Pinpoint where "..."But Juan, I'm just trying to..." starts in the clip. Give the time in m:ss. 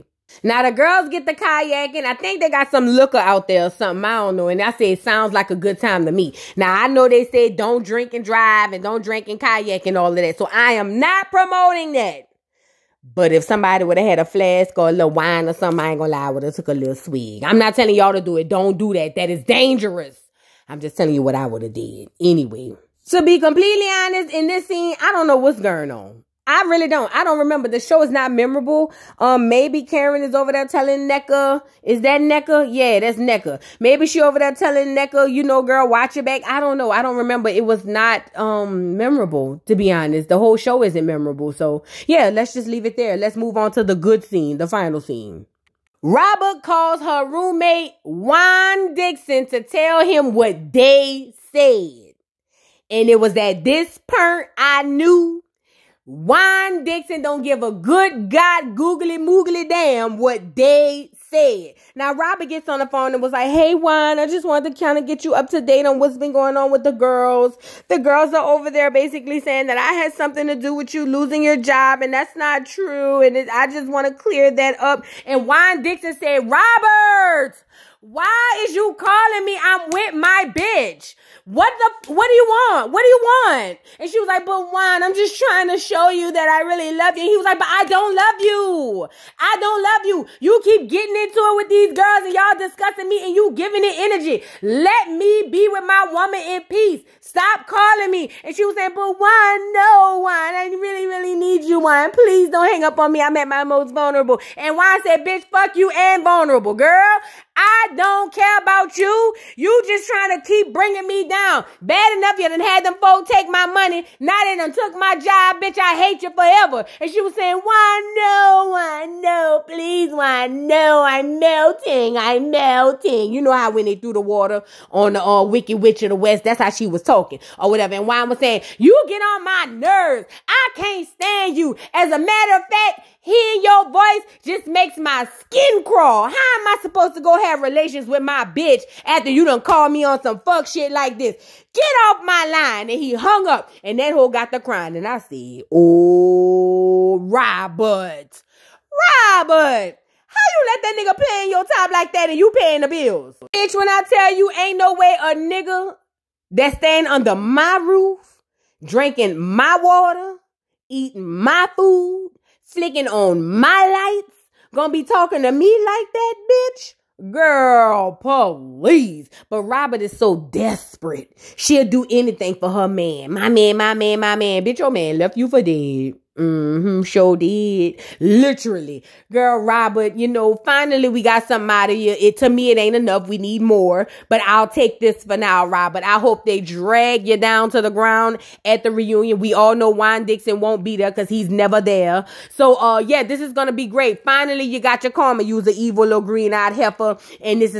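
1:24.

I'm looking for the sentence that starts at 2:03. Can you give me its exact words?
You know how when they threw the water on the uh, Witch of the West, that's how she was talking or whatever.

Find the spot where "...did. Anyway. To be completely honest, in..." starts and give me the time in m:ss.
0:21.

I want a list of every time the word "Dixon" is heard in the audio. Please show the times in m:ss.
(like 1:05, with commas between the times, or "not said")
0:48, 0:56, 1:15, 3:10.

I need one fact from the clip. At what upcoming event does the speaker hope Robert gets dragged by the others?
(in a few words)
the reunion.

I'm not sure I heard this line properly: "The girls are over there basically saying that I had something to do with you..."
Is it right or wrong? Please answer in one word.
right.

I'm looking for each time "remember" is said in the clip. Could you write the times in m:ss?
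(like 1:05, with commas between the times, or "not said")
0:27, 0:37.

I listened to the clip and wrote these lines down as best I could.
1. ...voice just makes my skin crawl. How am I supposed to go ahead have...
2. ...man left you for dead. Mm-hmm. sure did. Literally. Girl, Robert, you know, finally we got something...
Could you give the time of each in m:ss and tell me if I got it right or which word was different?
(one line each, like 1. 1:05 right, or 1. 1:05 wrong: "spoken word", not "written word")
1. 2:13 right
2. 2:54 right.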